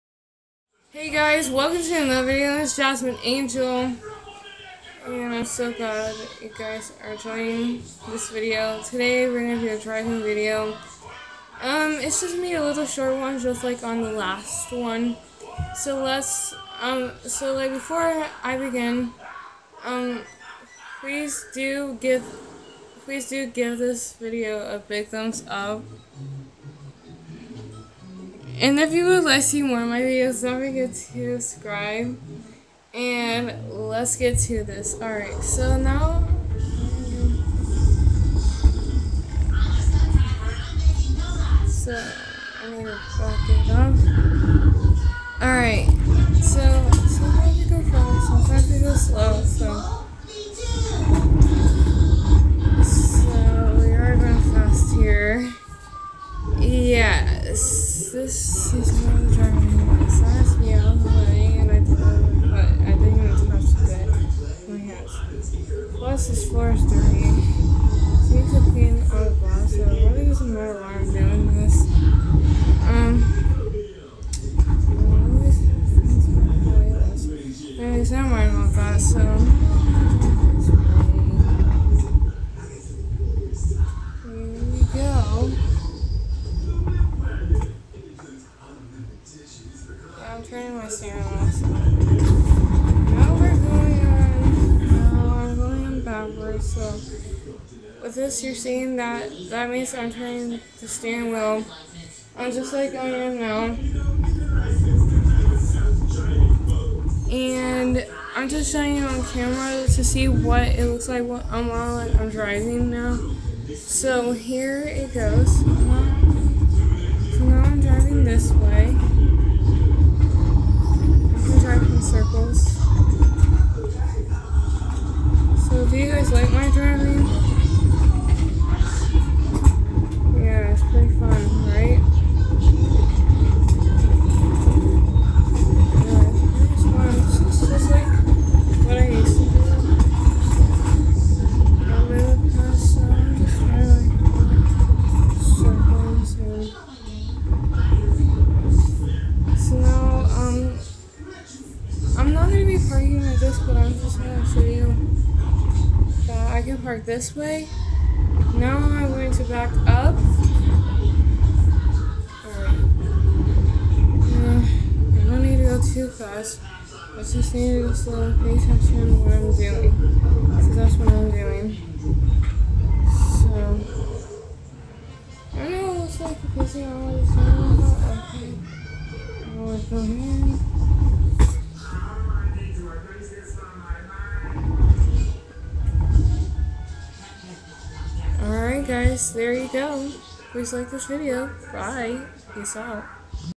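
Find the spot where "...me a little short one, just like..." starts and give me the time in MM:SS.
00:12.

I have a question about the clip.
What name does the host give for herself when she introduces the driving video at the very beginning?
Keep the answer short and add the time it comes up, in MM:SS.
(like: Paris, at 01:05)
Jasmine Angel, at 00:02.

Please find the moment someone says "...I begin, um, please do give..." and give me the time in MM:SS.
00:18.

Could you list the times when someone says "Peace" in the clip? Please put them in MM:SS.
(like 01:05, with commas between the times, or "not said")
03:12.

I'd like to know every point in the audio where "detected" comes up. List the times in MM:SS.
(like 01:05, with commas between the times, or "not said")
not said.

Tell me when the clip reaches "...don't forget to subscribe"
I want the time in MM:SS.
00:30.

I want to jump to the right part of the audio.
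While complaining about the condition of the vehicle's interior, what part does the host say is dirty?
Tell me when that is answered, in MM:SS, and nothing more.
01:06.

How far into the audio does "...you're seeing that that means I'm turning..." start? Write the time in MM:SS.
01:38.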